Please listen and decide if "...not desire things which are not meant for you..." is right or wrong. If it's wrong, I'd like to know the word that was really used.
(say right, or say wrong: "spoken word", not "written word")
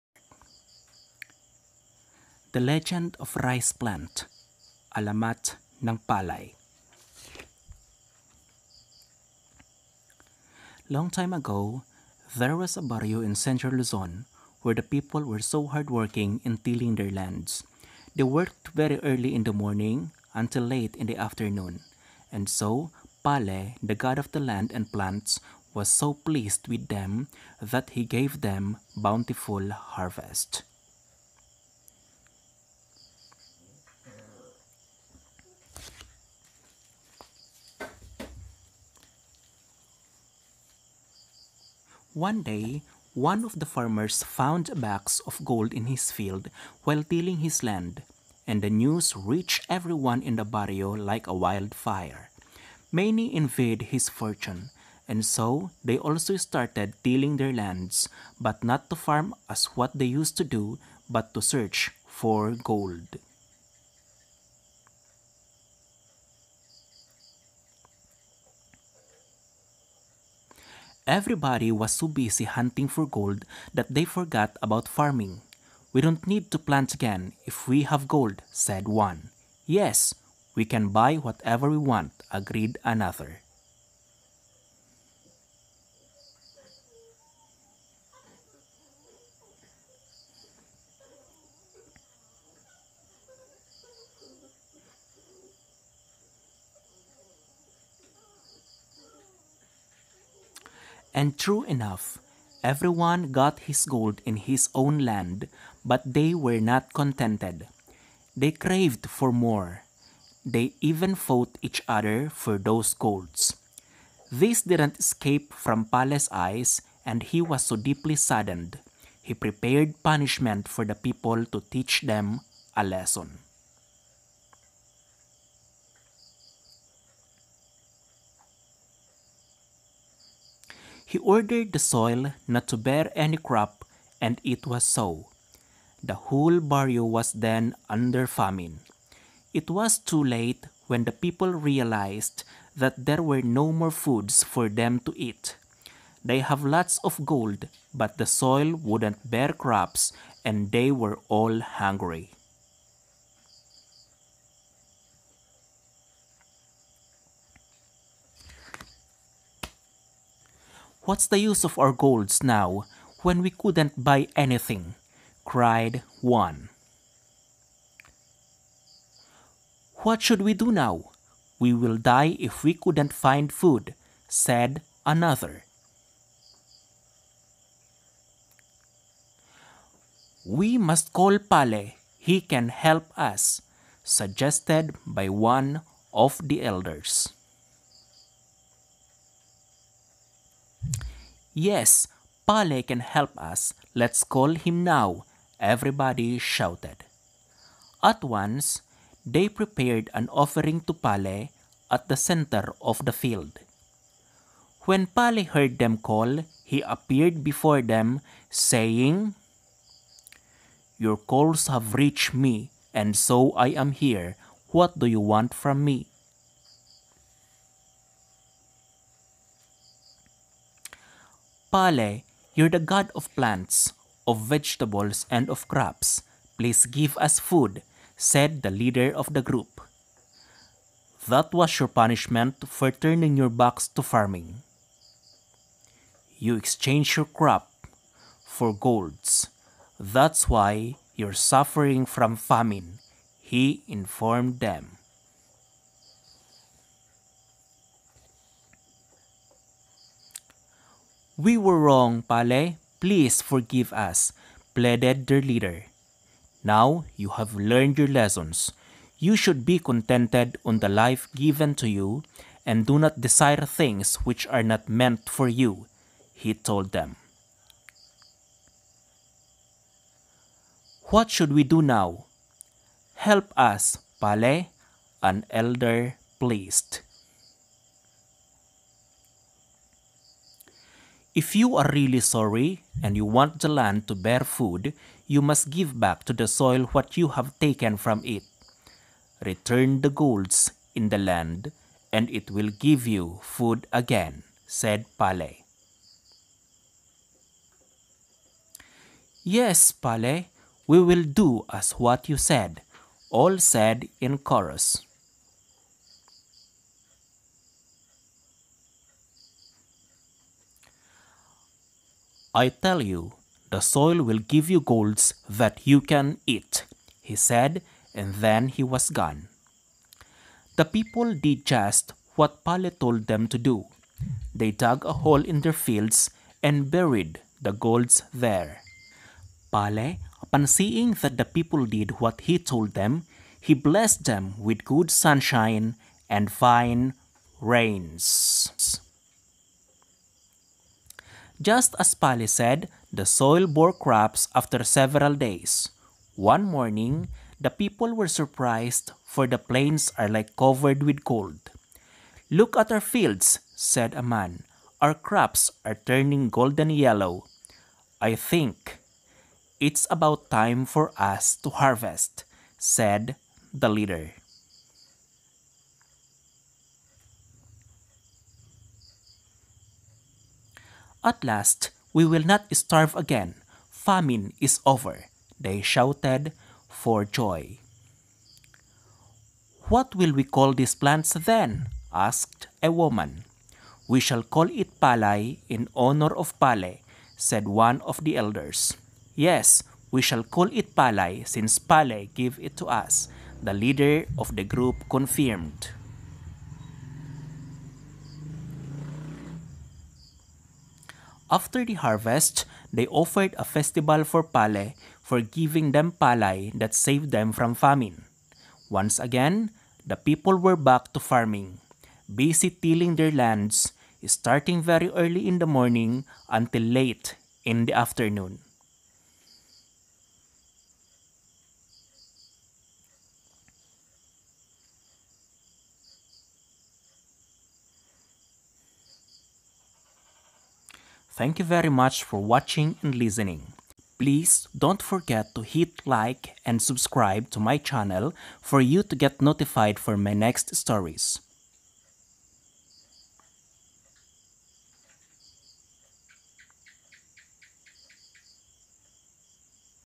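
right.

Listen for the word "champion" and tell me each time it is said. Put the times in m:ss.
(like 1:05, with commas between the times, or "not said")
not said.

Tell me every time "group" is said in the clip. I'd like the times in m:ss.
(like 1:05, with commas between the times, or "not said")
3:49, 6:34.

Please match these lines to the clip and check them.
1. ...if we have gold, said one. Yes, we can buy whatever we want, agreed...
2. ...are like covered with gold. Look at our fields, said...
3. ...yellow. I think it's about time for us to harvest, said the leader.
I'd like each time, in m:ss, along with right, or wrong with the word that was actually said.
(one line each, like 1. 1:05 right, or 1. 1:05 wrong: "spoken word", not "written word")
1. 1:17 right
2. 5:50 right
3. 5:56 right.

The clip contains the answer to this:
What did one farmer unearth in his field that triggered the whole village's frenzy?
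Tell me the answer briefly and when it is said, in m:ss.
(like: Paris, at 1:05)
A box of gold, at 0:44.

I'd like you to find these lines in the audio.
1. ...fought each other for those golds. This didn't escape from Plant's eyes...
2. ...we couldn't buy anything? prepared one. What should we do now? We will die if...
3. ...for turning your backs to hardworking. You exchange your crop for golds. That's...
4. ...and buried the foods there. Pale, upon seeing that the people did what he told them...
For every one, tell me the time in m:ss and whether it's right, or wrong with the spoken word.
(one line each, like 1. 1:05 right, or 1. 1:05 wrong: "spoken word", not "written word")
1. 1:51 wrong: "Pale", not "Plant"
2. 2:43 wrong: "cried", not "prepared"
3. 3:52 wrong: "farming", not "hardworking"
4. 5:26 wrong: "golds", not "foods".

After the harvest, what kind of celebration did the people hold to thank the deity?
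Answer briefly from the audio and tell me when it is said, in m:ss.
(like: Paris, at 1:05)
A festival, at 6:43.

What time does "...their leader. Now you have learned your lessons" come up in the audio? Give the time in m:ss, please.
4:15.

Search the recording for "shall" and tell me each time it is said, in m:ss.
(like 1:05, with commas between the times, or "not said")
6:24, 6:30.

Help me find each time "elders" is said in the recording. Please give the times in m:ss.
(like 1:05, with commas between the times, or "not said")
3:06, 4:35, 6:28.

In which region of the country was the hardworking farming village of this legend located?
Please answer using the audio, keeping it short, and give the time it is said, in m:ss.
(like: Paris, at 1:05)
Central Luzon, at 0:13.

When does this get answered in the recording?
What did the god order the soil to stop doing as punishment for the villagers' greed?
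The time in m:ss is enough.
2:12.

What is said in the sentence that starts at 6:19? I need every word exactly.
What will we call these plants then?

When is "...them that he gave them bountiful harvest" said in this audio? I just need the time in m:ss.
0:26.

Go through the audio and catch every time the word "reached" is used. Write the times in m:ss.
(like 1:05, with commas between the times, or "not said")
0:49, 3:31.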